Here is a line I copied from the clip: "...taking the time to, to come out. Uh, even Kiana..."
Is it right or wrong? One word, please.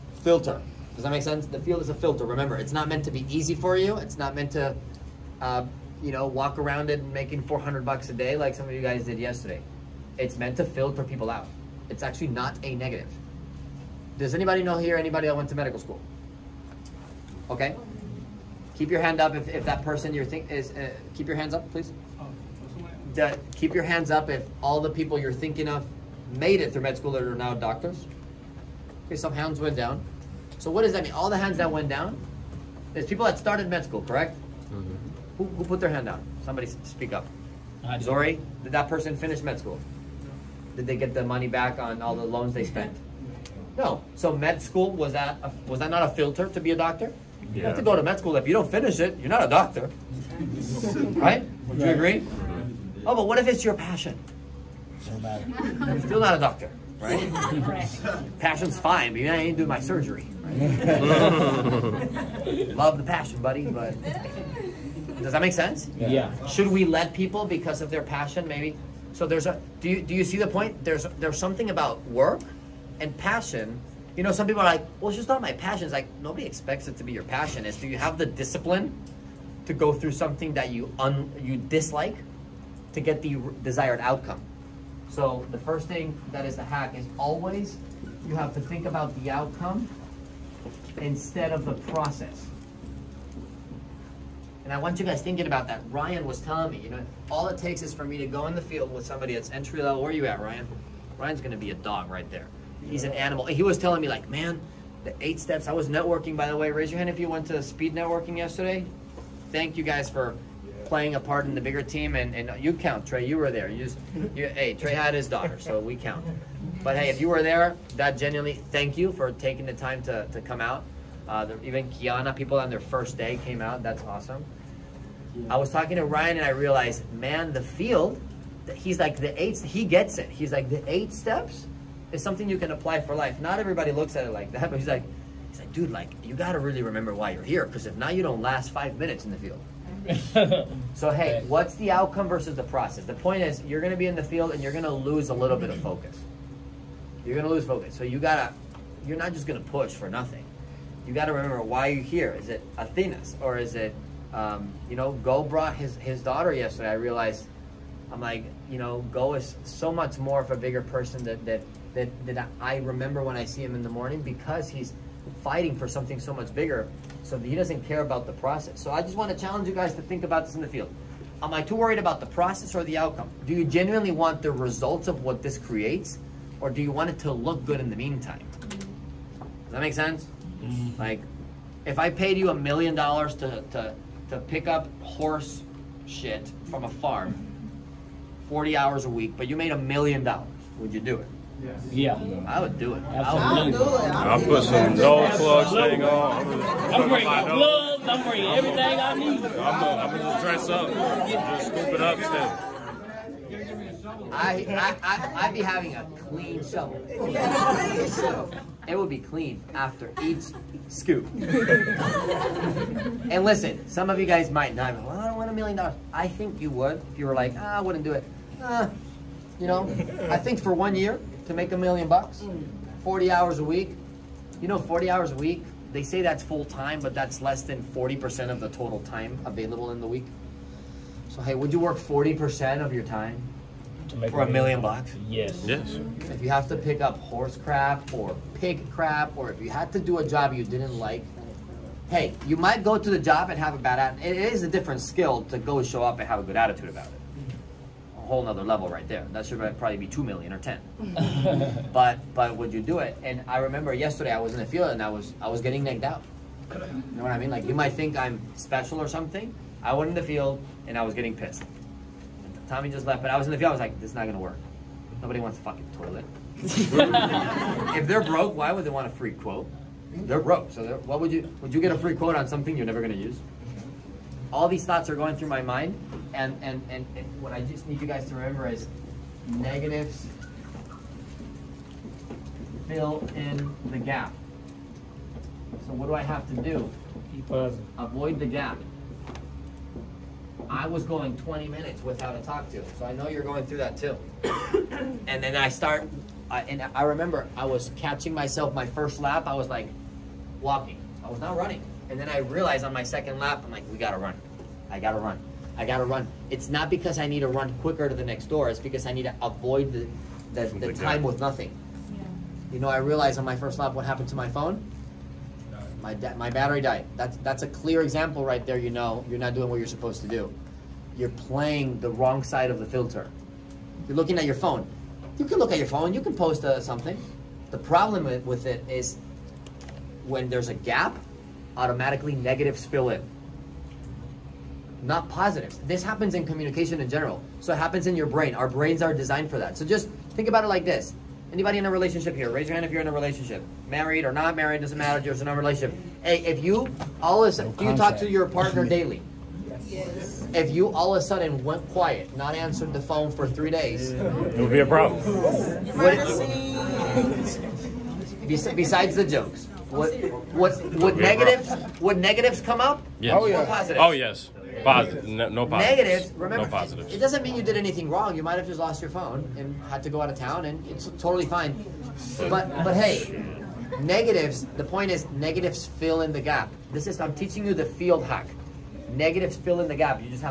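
right.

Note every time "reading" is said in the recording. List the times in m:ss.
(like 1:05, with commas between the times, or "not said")
not said.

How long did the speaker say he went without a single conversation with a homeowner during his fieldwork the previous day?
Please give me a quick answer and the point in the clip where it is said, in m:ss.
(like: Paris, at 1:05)
20 minutes, at 4:51.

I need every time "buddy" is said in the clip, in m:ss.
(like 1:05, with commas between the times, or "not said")
1:03.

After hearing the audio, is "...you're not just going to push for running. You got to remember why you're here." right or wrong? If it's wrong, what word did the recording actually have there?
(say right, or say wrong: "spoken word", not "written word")
wrong: "nothing", not "running".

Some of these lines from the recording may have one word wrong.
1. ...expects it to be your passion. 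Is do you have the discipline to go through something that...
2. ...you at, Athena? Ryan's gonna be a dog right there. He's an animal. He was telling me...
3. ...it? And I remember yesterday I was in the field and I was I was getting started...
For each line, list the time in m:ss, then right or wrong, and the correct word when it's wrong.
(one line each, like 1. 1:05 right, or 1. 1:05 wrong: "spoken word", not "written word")
1. 1:16 right
2. 1:40 wrong: "Ryan", not "Athena"
3. 4:12 wrong: "negged", not "started".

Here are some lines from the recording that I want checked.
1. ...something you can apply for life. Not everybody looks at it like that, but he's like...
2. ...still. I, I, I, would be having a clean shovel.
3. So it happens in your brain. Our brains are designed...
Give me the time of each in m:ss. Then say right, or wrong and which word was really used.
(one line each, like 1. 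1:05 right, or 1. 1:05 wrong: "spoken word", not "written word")
1. 2:12 right
2. 3:22 right
3. 5:37 right.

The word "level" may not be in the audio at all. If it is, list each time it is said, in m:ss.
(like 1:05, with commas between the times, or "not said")
1:39, 4:08.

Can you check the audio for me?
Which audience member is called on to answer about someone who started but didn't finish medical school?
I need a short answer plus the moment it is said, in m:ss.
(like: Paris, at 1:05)
Zori, at 0:37.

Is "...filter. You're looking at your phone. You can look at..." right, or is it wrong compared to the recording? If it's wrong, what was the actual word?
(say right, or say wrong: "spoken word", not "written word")
right.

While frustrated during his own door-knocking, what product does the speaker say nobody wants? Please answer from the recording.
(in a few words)
toilet.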